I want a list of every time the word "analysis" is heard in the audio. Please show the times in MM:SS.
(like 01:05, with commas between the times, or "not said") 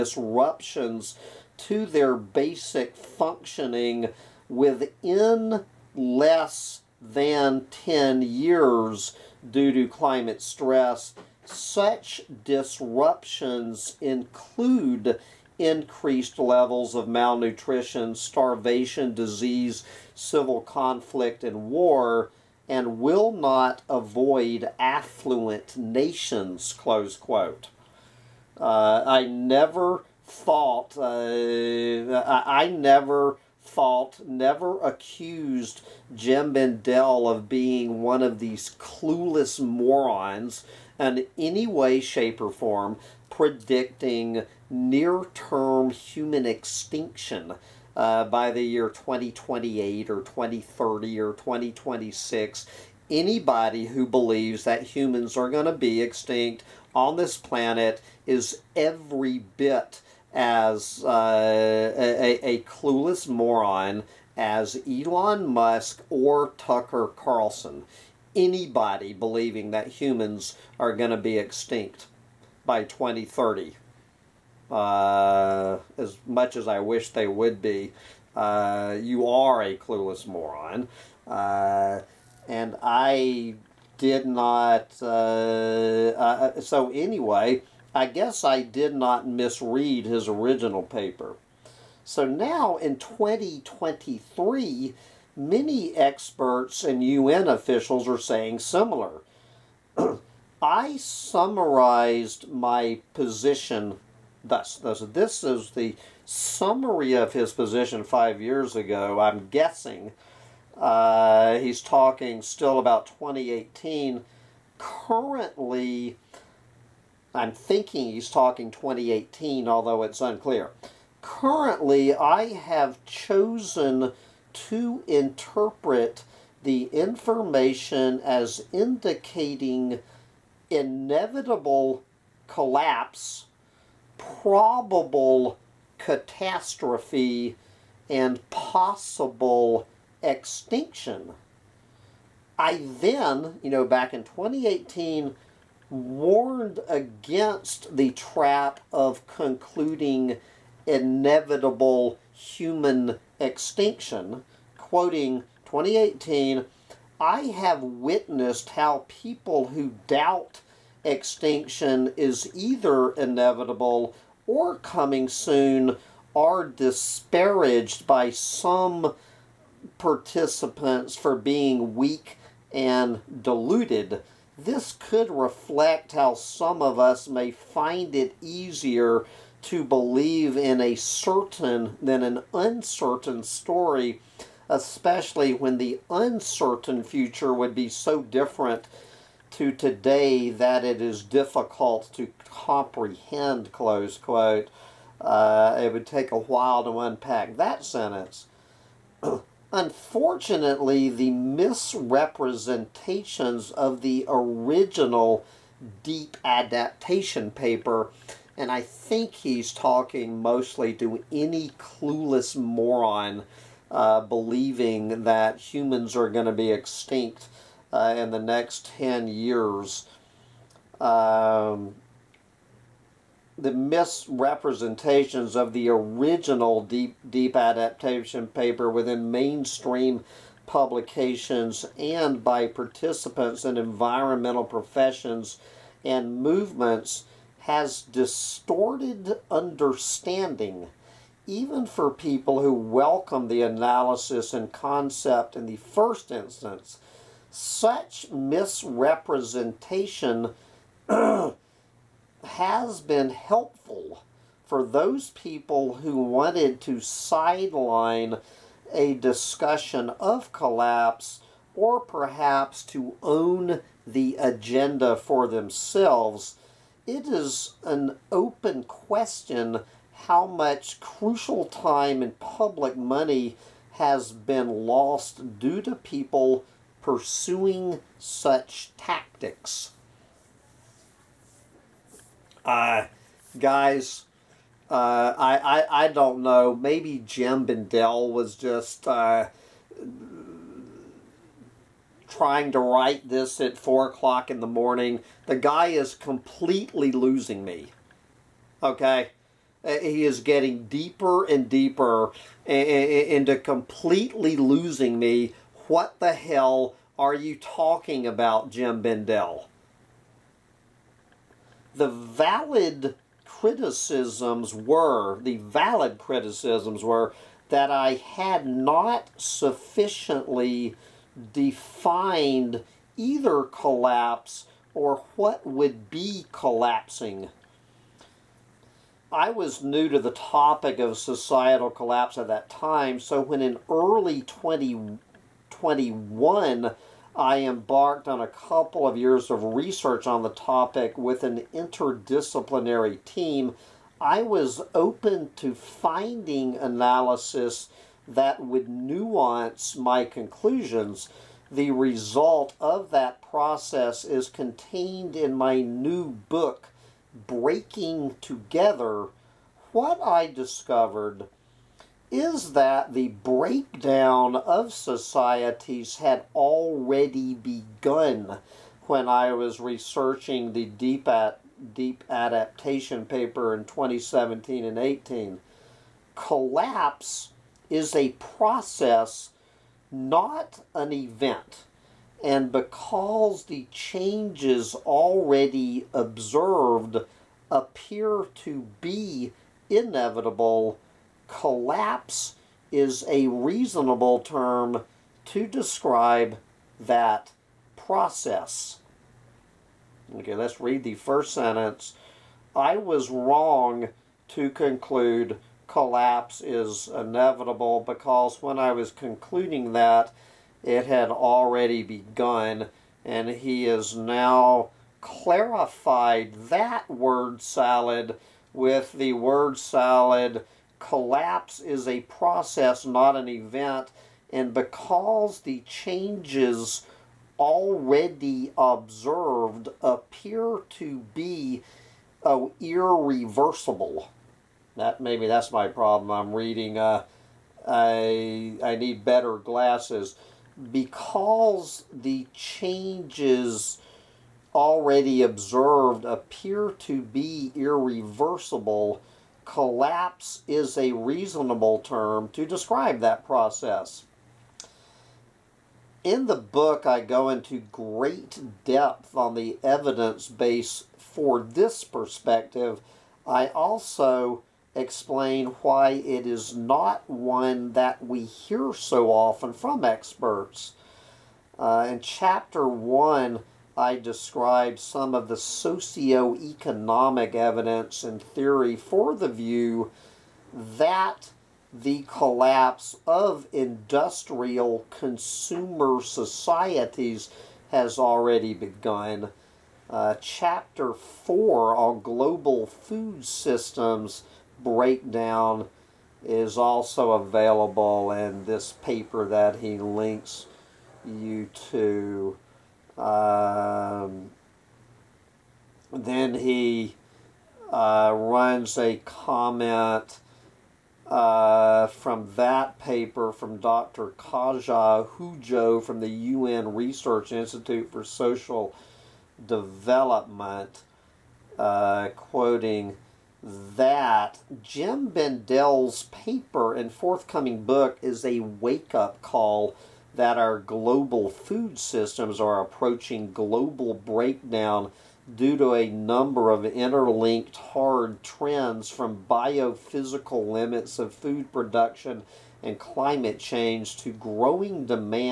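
04:03, 05:46.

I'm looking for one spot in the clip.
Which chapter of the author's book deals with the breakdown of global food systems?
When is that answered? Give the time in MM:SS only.
08:10.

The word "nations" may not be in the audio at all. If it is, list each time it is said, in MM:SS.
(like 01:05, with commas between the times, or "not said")
00:25.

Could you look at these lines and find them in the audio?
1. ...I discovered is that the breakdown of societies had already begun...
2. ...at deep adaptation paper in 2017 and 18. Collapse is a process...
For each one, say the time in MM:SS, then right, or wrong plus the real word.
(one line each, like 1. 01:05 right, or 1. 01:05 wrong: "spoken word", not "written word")
1. 06:00 right
2. 06:11 right.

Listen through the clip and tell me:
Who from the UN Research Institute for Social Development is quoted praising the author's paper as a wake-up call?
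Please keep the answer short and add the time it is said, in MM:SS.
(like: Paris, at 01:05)
Katja Hujo, at 08:34.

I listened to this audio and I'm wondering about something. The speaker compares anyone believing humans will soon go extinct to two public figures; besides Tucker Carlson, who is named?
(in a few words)
Elon Musk.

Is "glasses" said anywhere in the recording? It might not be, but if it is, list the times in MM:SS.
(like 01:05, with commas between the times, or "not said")
07:19.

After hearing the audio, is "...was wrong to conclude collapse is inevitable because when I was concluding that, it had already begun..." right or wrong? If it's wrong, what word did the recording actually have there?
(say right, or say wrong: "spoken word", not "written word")
right.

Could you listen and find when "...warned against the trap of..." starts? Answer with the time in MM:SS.
02:25.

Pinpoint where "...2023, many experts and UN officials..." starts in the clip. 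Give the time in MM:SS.
01:32.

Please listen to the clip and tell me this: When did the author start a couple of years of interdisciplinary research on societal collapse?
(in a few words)
early 2021.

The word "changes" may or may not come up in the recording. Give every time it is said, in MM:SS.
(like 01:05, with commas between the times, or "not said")
06:23, 07:05, 07:22, 09:03.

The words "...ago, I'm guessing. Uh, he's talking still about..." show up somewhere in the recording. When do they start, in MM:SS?
01:48.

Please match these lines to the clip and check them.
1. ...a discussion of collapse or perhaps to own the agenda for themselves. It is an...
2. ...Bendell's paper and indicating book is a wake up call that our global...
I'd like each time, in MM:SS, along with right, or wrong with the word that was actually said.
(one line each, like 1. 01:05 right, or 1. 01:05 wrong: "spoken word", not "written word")
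1. 04:18 right
2. 08:45 wrong: "forthcoming", not "indicating".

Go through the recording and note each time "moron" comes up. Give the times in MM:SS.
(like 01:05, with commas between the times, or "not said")
00:39, 01:03, 01:20, 03:32.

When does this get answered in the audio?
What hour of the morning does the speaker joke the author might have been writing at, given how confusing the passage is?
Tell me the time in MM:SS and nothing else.
04:53.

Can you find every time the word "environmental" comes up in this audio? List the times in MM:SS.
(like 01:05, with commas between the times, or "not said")
03:53.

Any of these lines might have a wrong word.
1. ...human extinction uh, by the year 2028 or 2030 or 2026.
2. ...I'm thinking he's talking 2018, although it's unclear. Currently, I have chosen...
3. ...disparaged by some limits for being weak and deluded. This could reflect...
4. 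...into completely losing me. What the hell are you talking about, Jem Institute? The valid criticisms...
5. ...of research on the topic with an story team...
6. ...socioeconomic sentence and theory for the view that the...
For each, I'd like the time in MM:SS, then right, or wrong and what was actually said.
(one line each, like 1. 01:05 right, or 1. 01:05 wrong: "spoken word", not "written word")
1. 00:45 right
2. 01:57 right
3. 02:46 wrong: "participants", not "limits"
4. 05:02 wrong: "Bendell", not "Institute"
5. 05:39 wrong: "interdisciplinary", not "story"
6. 07:55 wrong: "evidence", not "sentence".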